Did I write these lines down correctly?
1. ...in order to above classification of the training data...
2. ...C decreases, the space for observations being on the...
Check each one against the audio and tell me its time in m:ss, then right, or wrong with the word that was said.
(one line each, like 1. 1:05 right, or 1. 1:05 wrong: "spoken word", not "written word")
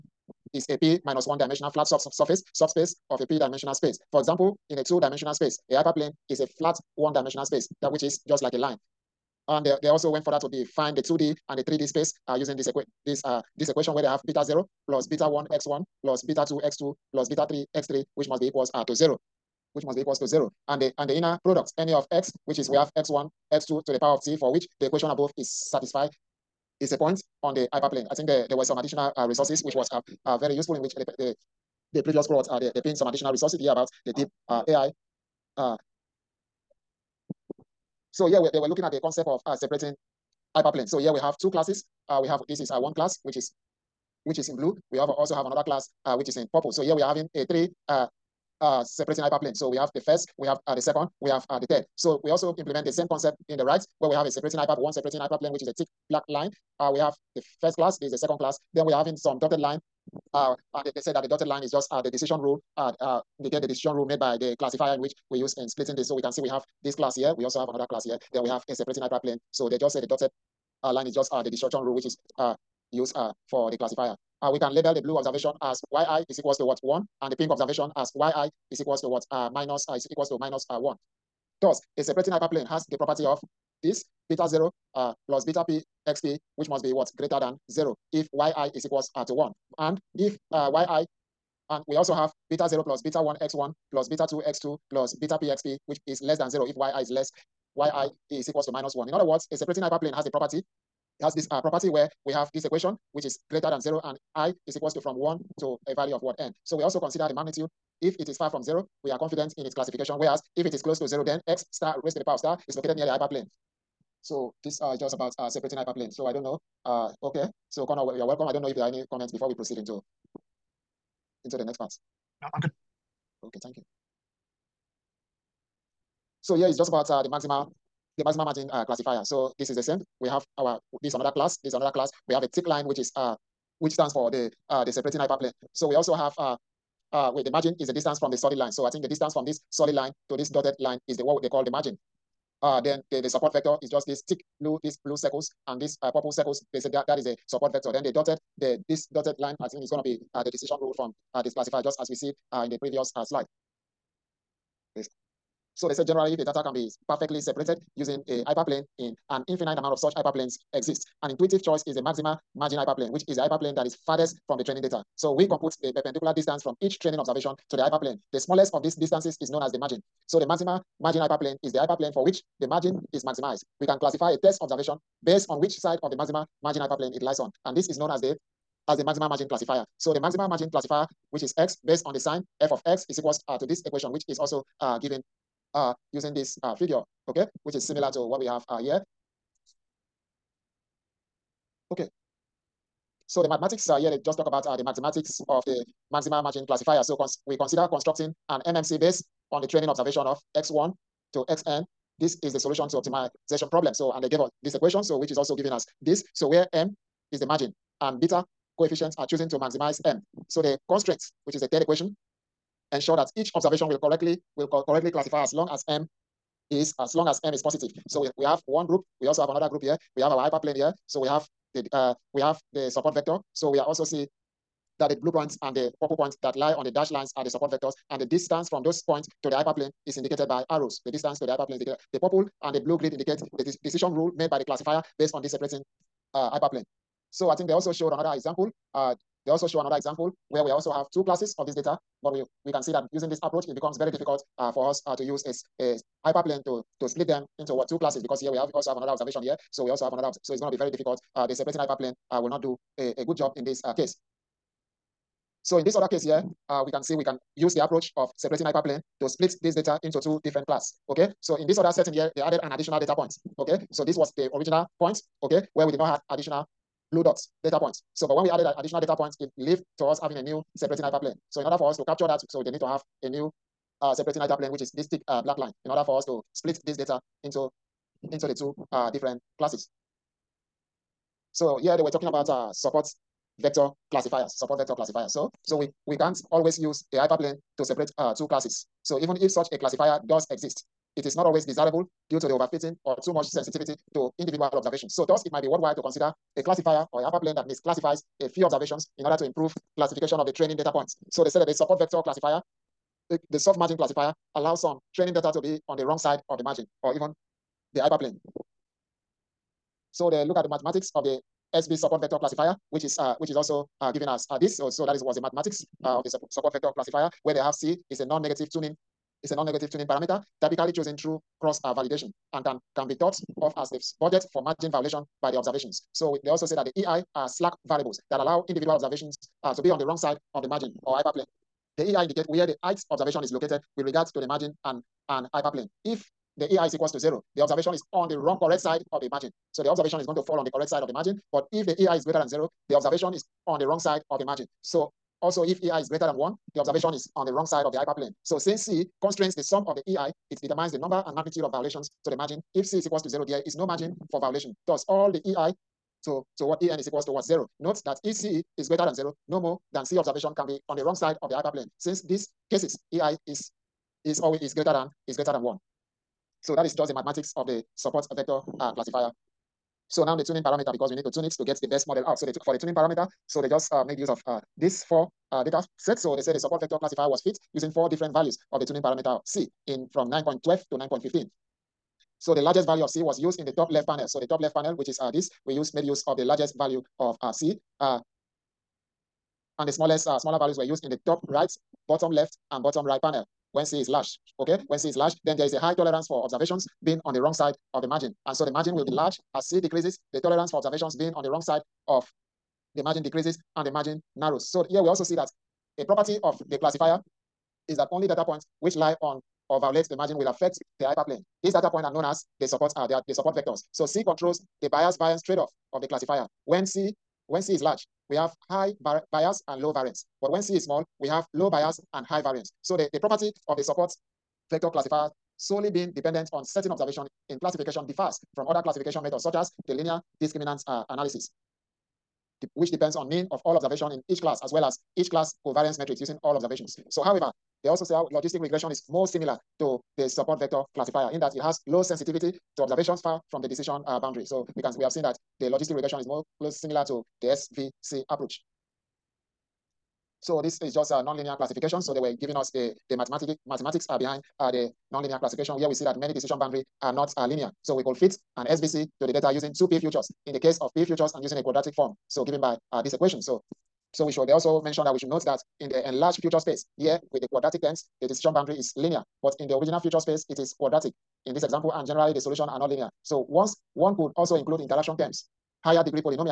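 1. 4:59 wrong: "improve", not "above"
2. 6:39 wrong: "tolerance", not "space".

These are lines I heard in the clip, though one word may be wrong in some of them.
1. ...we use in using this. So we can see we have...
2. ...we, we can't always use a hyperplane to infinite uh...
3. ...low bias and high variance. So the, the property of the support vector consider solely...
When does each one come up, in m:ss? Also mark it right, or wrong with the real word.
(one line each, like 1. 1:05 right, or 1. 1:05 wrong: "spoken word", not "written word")
1. 1:05 wrong: "splitting", not "using"
2. 4:45 wrong: "separate", not "infinite"
3. 7:01 wrong: "classifier", not "consider".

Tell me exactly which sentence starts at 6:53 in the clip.
So C controls the bias variance trade-off of the classifier.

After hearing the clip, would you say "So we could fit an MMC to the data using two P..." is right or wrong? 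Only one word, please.
wrong.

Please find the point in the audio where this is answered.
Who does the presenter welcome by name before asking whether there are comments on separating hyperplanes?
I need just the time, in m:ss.
1:57.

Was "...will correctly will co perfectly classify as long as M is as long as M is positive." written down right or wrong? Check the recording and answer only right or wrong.
wrong.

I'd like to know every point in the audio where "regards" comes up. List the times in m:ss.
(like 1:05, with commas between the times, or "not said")
5:34.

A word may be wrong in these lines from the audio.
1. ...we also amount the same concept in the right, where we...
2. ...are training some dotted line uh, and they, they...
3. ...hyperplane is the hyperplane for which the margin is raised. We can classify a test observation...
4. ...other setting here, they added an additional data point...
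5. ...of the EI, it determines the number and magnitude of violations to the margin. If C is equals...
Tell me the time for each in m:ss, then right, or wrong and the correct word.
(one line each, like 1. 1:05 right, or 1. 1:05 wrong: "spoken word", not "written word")
1. 0:52 wrong: "implement", not "amount"
2. 0:58 wrong: "having", not "training"
3. 2:51 wrong: "maximized", not "raised"
4. 4:21 right
5. 5:49 right.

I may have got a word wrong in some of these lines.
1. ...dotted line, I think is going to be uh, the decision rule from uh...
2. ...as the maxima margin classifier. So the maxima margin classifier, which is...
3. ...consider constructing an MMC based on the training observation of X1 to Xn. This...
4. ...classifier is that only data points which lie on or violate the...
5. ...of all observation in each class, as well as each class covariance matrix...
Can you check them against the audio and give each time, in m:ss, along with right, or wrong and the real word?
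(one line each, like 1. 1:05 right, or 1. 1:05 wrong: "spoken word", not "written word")
1. 2:29 right
2. 2:58 right
3. 3:17 right
4. 6:46 right
5. 7:13 right.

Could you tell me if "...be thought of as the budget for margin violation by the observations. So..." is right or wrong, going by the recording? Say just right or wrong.
right.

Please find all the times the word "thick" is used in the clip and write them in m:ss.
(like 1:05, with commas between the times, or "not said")
0:55, 2:12, 2:24, 4:35.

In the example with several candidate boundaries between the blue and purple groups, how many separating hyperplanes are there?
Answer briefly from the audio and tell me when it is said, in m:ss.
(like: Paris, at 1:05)
3, at 0:47.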